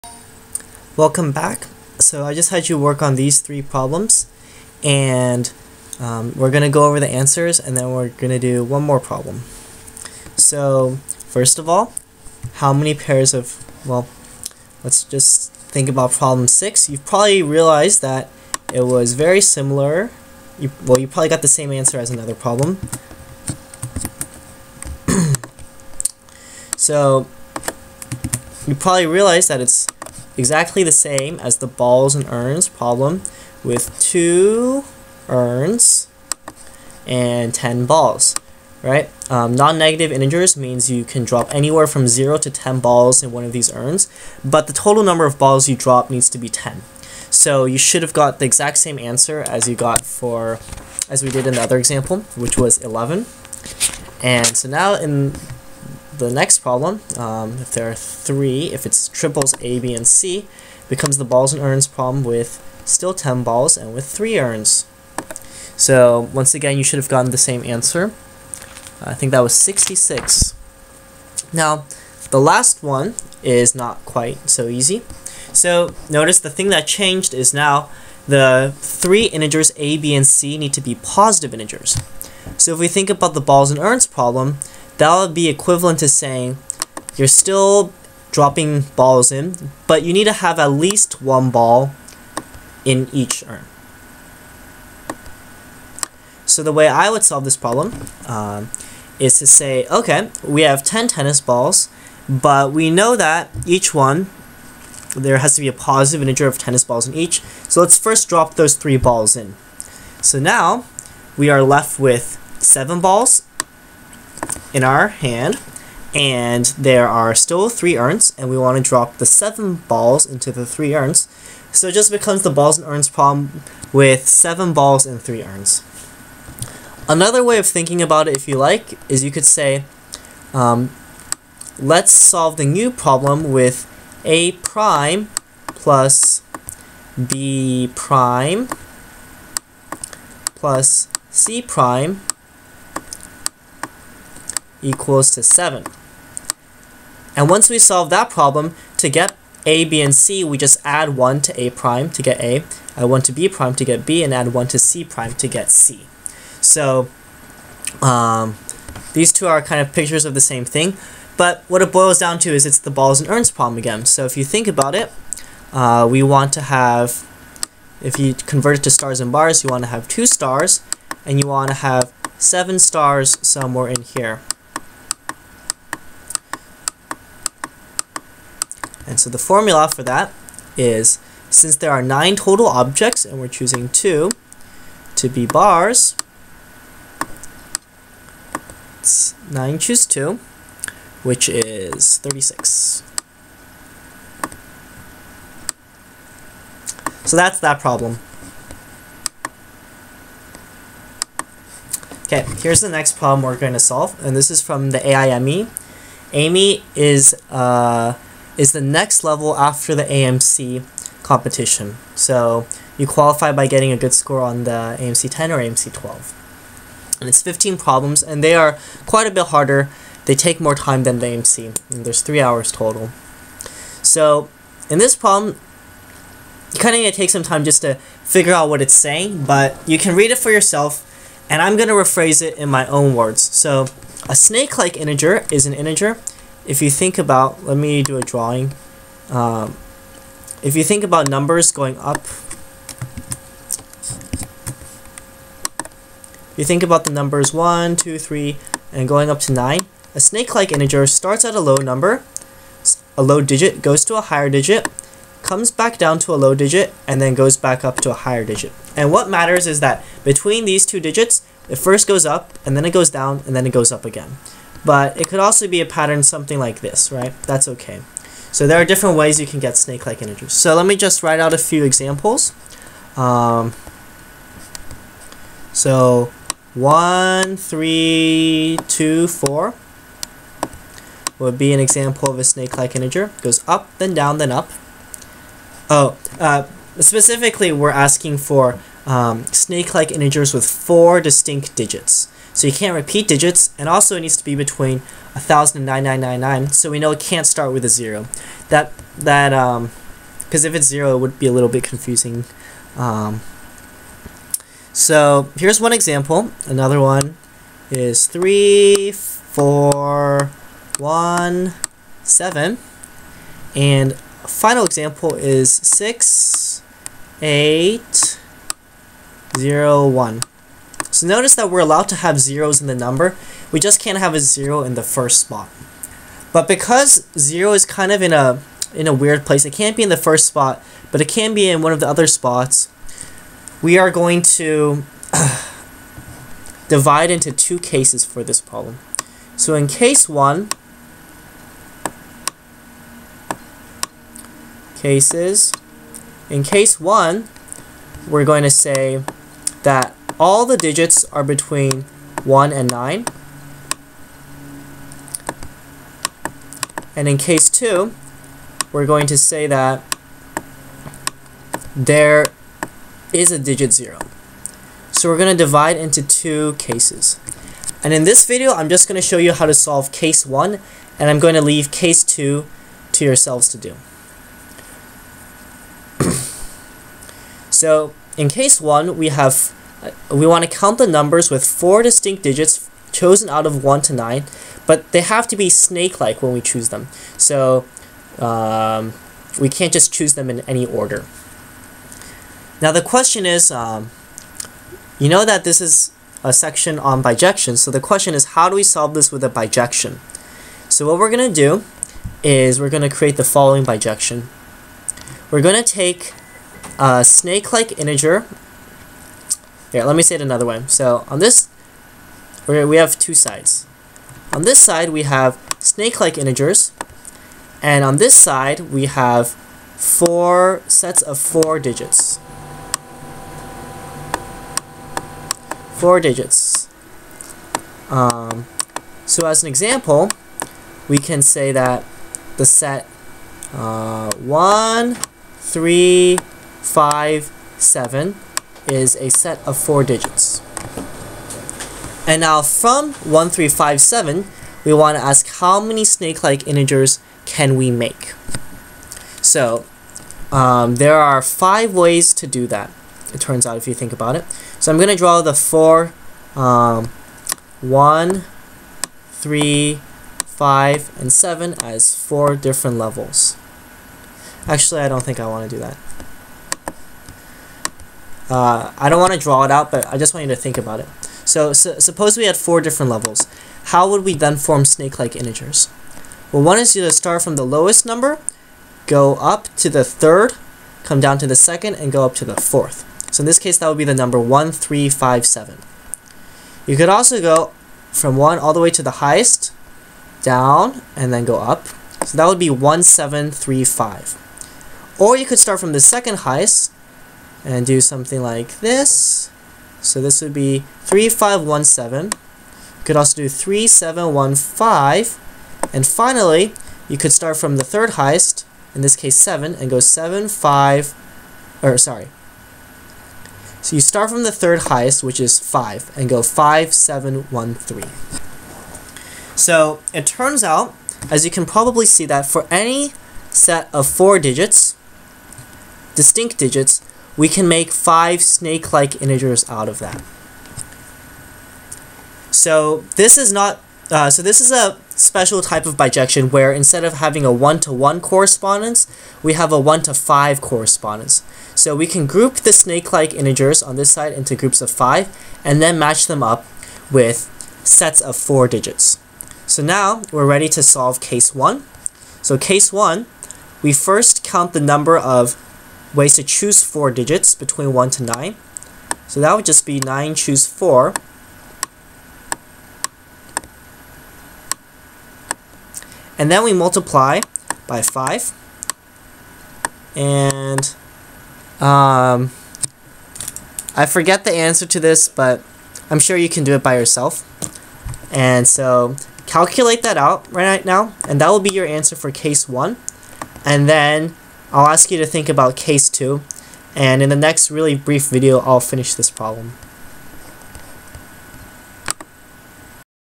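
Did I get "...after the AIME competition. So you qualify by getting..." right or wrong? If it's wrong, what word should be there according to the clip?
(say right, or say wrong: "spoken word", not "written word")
wrong: "AMC", not "AIME".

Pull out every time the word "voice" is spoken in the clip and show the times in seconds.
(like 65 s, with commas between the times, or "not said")
not said.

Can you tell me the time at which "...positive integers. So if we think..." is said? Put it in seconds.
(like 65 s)
80 s.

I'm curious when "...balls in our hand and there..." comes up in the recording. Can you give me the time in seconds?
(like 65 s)
112 s.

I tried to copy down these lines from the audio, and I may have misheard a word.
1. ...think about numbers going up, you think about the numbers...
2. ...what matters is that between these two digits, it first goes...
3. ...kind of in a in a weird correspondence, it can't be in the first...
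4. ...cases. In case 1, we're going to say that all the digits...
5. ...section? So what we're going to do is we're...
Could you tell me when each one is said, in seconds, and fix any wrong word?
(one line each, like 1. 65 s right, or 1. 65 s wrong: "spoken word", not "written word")
1. 240 s right
2. 259 s right
3. 327 s wrong: "place", not "correspondence"
4. 345 s right
5. 399 s wrong: "bijection", not "section".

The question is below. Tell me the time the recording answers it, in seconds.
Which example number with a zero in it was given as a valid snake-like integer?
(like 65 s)
315 s.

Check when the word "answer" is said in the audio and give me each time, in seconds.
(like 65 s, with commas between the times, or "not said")
7 s, 21 s, 48 s, 67 s, 574 s, 581 s.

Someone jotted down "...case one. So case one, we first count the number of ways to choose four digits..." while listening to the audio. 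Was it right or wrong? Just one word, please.
right.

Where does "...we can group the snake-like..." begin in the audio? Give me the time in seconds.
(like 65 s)
541 s.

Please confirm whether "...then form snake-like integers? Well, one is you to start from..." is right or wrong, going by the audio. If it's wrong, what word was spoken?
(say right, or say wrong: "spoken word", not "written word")
right.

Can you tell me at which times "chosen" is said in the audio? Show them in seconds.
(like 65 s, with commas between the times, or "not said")
383 s.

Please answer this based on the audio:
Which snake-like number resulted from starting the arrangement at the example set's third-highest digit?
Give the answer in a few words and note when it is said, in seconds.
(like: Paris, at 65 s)
5713, at 516 s.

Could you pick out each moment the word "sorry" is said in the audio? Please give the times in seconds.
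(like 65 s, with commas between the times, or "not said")
511 s.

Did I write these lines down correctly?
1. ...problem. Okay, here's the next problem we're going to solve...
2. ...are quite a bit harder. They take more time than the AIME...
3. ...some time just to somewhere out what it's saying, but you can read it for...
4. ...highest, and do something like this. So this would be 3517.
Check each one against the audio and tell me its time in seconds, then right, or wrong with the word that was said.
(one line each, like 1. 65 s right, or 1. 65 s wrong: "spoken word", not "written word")
1. 197 s right
2. 218 s wrong: "AMC", not "AIME"
3. 227 s wrong: "figure", not "somewhere"
4. 496 s right.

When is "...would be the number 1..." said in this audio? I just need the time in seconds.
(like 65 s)
483 s.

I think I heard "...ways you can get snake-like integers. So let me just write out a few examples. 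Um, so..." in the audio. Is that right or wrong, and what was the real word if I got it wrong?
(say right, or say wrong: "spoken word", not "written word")
right.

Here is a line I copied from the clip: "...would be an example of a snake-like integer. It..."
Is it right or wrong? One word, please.
right.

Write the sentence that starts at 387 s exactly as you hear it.
So um, we can't just choose them in any order.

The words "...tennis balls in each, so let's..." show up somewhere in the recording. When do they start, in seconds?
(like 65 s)
106 s.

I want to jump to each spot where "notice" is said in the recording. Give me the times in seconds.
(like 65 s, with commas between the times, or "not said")
76 s, 321 s.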